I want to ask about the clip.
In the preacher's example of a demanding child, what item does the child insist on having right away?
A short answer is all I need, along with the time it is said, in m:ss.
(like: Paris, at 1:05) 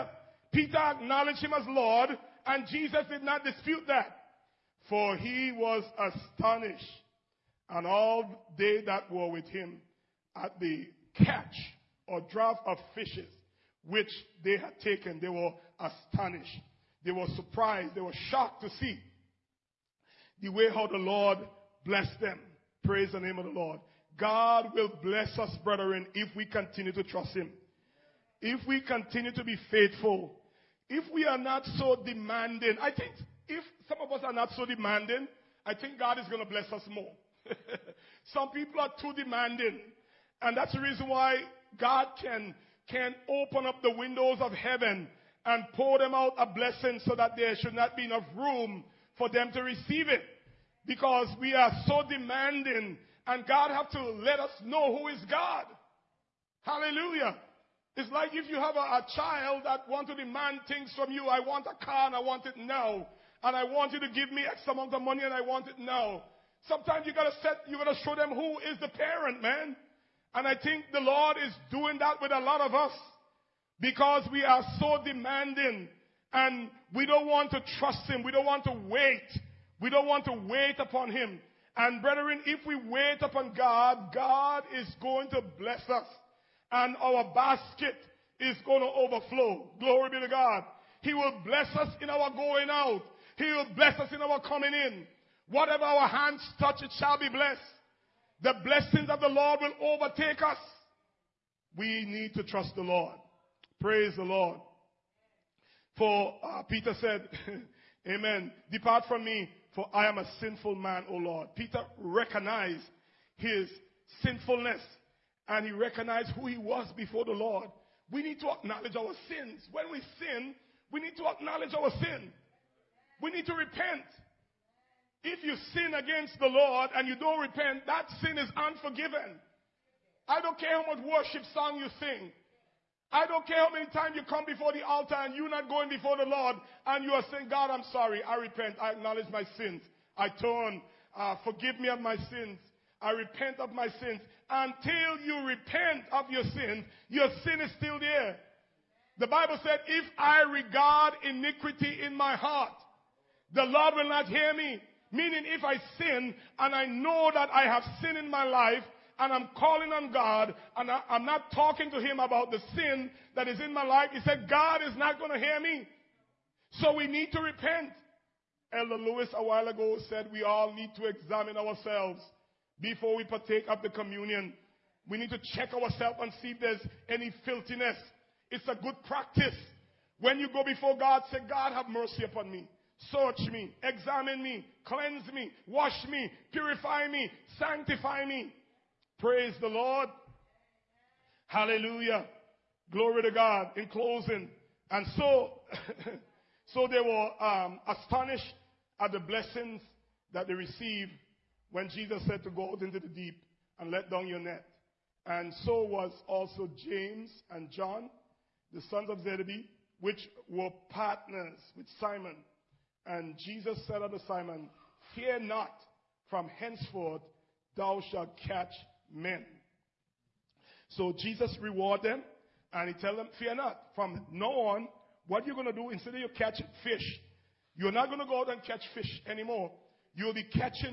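A car, at 1:01.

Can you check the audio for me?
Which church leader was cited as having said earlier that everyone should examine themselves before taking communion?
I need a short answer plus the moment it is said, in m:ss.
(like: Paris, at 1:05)
Elder Lewis, at 2:48.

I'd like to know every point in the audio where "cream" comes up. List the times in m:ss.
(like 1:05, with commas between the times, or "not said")
not said.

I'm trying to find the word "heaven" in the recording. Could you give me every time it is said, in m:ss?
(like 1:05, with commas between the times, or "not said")
0:44.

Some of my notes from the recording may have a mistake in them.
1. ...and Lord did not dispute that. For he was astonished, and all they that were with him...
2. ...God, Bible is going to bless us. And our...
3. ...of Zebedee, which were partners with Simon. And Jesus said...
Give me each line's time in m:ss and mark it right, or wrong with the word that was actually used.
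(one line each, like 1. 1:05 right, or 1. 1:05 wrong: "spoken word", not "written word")
1. 0:02 wrong: "Jesus", not "Lord"
2. 1:23 wrong: "God", not "Bible"
3. 3:29 right.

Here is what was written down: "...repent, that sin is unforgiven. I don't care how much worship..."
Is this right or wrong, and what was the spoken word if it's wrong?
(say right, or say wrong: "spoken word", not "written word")
right.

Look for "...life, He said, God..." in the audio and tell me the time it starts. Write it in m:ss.
2:43.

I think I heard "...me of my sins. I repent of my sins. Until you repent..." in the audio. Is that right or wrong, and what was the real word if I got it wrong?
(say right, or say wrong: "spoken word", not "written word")
right.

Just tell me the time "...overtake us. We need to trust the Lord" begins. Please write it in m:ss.
1:39.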